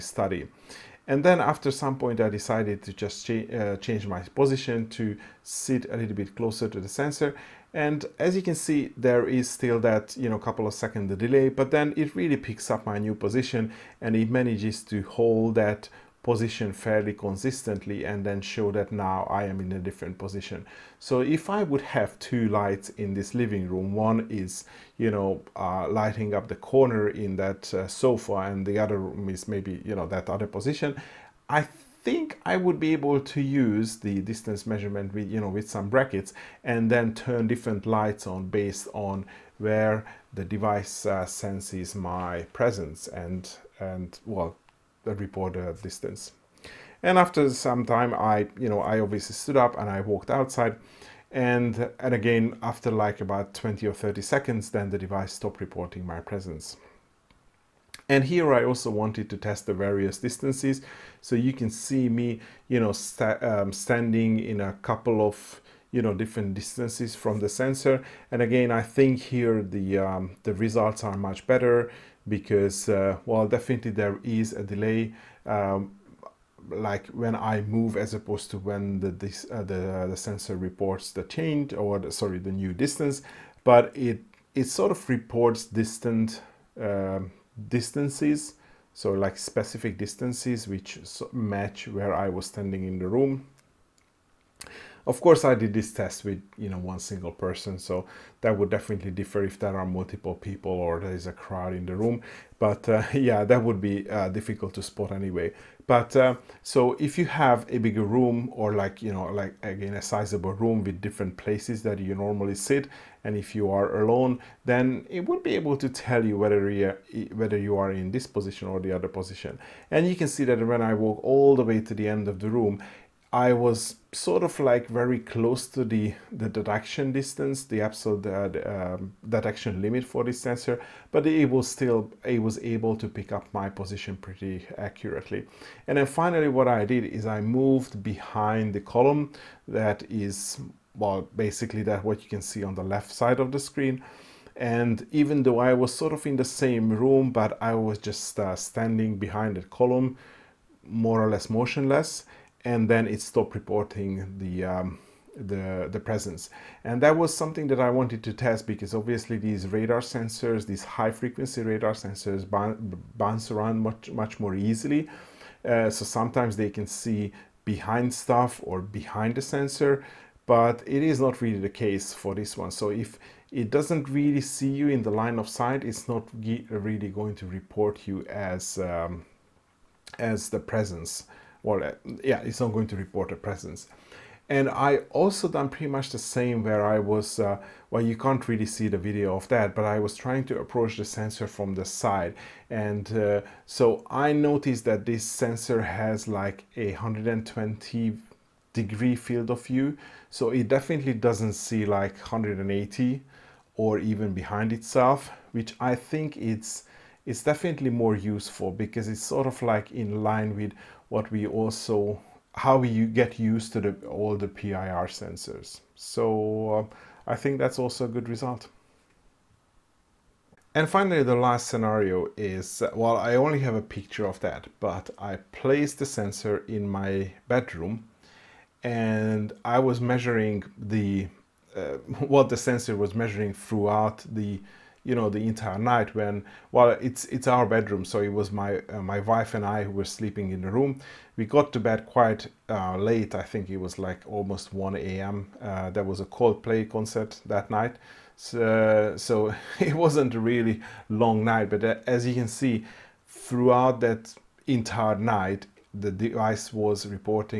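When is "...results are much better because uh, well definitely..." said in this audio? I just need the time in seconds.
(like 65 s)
70 s.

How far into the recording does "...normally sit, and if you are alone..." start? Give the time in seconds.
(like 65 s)
112 s.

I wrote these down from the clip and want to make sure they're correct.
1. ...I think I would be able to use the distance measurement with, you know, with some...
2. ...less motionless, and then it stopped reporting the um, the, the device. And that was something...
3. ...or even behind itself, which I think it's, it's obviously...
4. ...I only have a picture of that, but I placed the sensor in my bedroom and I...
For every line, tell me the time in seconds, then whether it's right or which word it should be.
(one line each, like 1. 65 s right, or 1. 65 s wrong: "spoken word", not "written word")
1. 31 s right
2. 151 s wrong: "presence", not "device"
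3. 203 s wrong: "definitely", not "obviously"
4. 223 s right.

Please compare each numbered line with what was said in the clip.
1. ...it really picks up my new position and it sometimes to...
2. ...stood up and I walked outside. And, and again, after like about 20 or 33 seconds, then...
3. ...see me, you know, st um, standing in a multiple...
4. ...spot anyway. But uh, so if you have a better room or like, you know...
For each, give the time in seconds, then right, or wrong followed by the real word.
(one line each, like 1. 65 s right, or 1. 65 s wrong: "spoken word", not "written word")
1. 11 s wrong: "manages", not "sometimes"
2. 49 s wrong: "30", not "33"
3. 61 s wrong: "couple", not "multiple"
4. 104 s wrong: "bigger", not "better".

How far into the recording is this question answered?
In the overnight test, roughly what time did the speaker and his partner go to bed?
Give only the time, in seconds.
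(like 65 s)
244 s.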